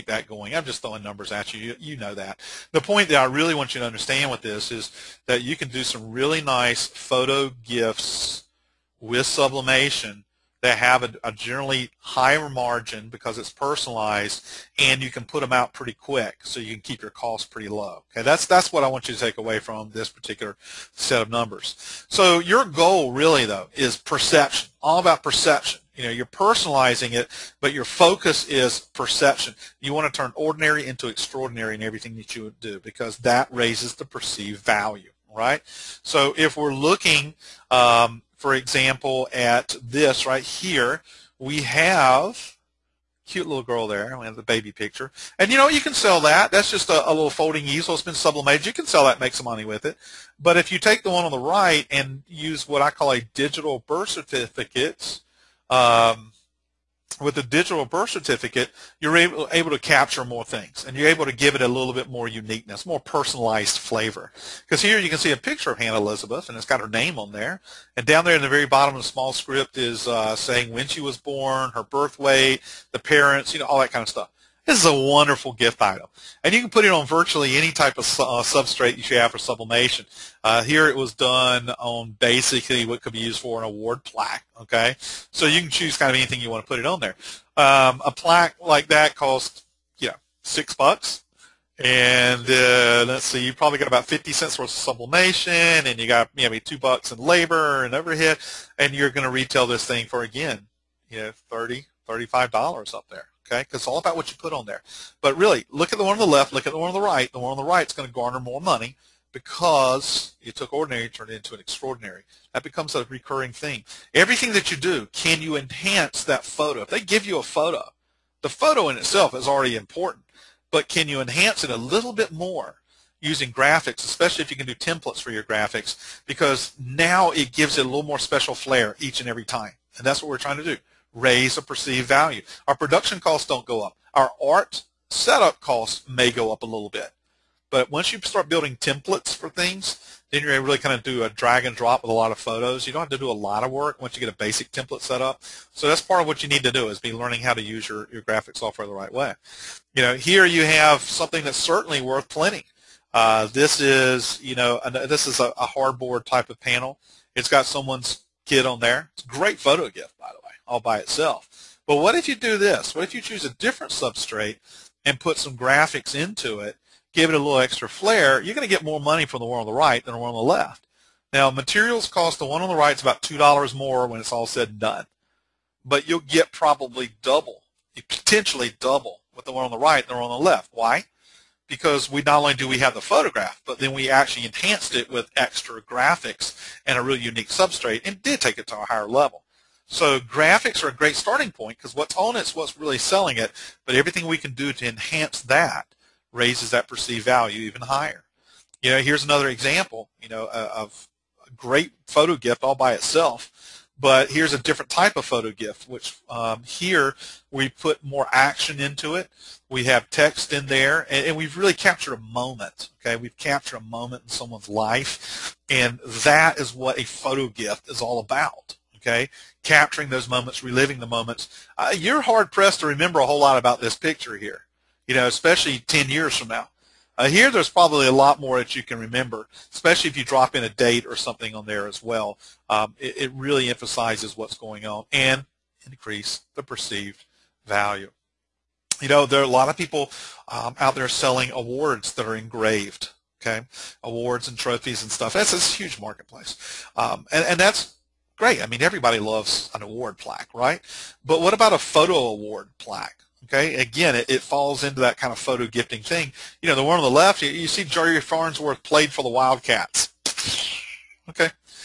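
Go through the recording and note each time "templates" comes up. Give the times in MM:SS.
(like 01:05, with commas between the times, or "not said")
02:04, 02:18, 02:24.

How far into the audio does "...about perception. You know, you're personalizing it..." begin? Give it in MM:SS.
00:24.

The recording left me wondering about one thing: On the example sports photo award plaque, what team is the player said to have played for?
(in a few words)
the Wildcats.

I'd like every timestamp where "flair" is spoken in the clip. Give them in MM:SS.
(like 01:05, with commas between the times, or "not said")
02:08, 02:47.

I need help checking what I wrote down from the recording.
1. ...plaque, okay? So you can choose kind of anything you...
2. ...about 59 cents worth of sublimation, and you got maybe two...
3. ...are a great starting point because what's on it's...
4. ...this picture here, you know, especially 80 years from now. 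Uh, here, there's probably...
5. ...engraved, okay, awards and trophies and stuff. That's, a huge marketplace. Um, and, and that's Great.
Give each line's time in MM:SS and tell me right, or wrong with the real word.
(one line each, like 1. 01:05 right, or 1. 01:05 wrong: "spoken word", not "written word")
1. 01:24 right
2. 01:33 wrong: "50", not "59"
3. 03:10 right
4. 03:43 wrong: "10", not "80"
5. 04:02 right.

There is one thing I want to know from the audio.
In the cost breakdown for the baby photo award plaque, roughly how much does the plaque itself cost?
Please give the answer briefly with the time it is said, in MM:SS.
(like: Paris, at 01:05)
$6, at 01:30.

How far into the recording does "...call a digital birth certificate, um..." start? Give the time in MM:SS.
00:52.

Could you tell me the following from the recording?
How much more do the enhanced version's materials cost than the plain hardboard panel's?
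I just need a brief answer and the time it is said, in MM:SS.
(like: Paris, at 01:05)
$2, at 02:53.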